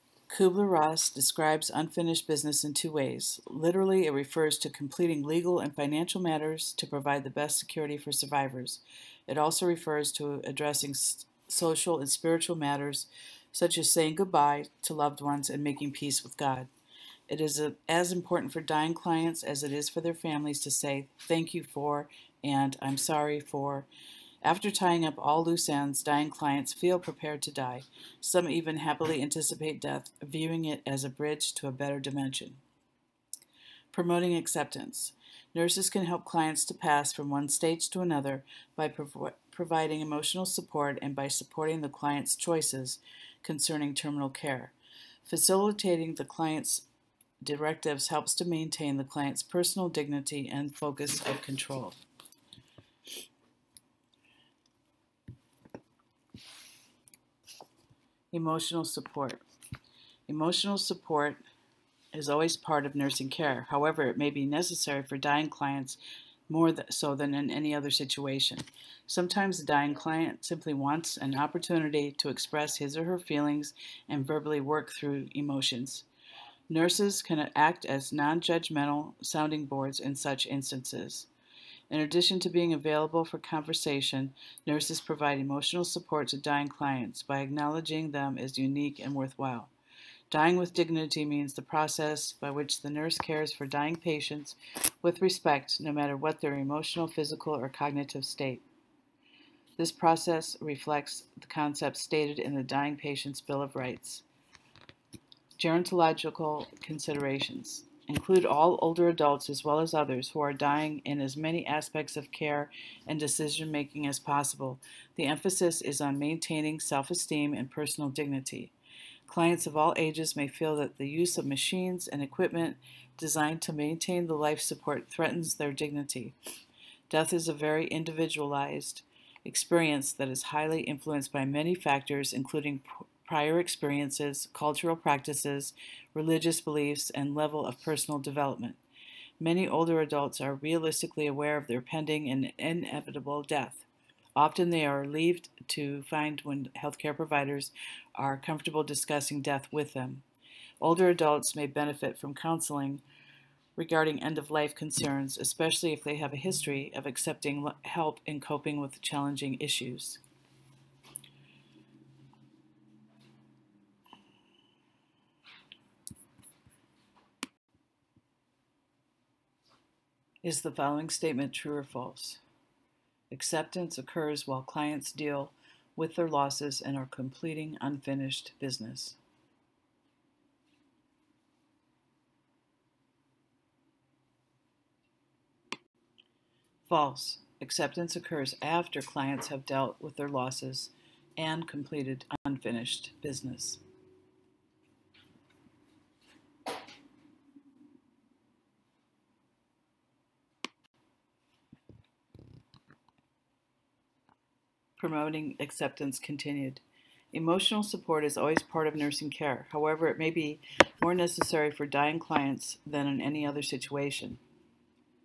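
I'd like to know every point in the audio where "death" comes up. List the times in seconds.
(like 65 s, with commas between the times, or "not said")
29 s, 127 s, 143 s, 149 s.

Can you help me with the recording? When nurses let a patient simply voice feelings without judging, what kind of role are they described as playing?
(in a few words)
Non judgmental sounding boards.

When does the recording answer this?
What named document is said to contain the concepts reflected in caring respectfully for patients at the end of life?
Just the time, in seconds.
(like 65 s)
102 s.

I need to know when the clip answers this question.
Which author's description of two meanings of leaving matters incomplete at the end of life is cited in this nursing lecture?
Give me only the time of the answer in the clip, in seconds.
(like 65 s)
0 s.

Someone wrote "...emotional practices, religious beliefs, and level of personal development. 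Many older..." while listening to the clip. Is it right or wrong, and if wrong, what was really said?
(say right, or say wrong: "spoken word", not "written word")
wrong: "cultural", not "emotional".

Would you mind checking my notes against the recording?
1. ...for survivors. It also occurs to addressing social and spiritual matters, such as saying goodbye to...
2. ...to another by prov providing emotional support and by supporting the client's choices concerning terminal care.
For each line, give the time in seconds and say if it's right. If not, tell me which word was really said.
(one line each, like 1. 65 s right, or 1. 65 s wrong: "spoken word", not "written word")
1. 7 s wrong: "refers", not "occurs"
2. 37 s right.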